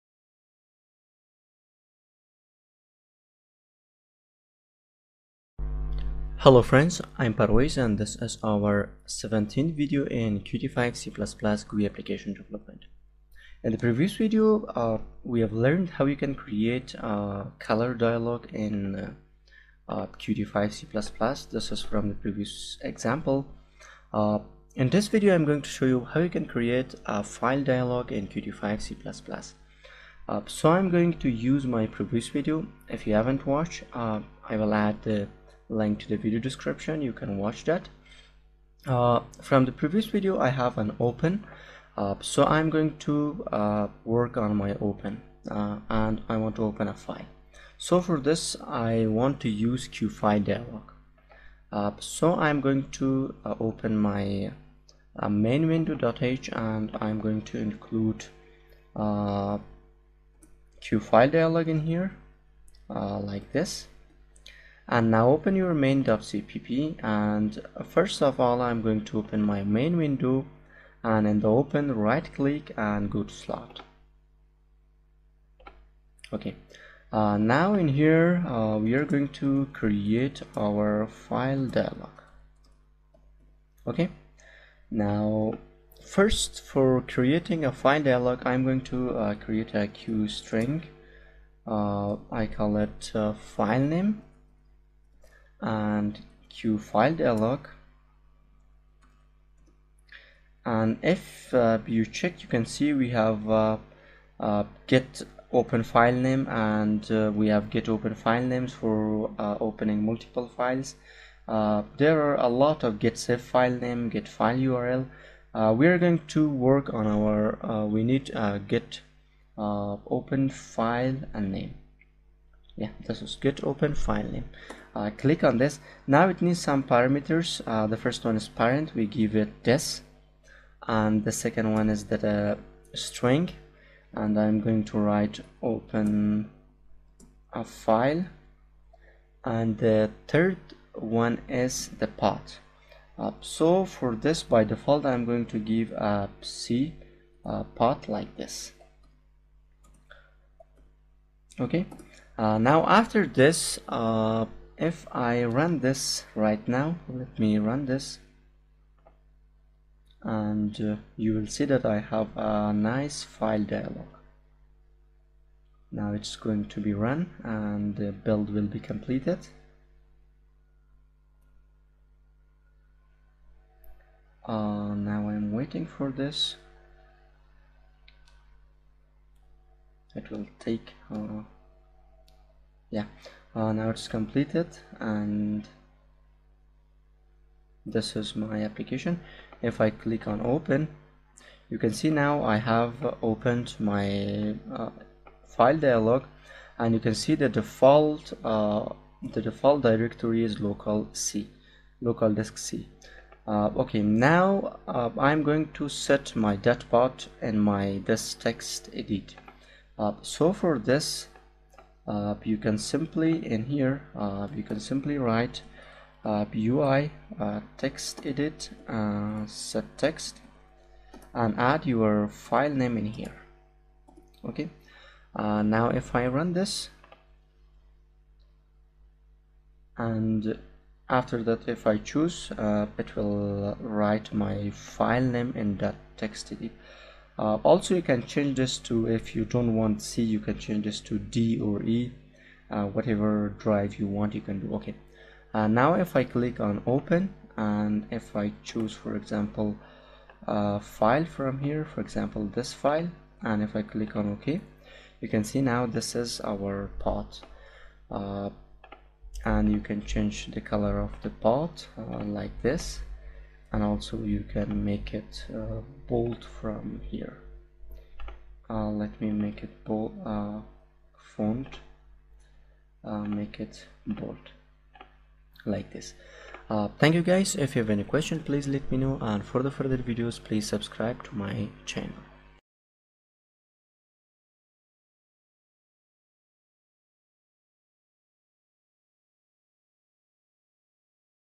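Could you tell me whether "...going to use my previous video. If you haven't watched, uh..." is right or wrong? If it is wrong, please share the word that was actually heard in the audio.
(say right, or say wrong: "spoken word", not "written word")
right.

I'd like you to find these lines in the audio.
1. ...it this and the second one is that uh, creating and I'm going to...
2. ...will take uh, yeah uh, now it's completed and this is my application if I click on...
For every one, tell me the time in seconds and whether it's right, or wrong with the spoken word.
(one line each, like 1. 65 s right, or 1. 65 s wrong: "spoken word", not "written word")
1. 129 s wrong: "string", not "creating"
2. 180 s right.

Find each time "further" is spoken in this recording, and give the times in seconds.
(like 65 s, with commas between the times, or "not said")
279 s.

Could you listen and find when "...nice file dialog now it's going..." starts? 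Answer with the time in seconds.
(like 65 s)
162 s.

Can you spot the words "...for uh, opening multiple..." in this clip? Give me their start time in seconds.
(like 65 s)
108 s.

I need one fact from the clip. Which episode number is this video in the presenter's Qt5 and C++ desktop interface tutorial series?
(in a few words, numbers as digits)
17th.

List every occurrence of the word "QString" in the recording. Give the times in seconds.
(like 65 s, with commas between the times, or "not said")
89 s.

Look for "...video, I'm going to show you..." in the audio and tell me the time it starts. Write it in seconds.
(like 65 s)
25 s.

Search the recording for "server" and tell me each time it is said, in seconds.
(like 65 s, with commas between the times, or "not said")
not said.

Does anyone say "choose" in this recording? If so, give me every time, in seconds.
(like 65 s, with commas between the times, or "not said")
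231 s, 248 s.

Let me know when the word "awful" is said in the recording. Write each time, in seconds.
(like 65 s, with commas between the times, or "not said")
not said.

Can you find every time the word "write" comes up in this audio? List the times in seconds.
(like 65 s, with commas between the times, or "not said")
134 s, 215 s, 233 s.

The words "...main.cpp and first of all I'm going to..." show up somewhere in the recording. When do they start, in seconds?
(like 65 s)
65 s.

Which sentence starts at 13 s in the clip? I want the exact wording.
In the previous video, uh, we have learned how you can create a color dialog in uh, Qt5 C++.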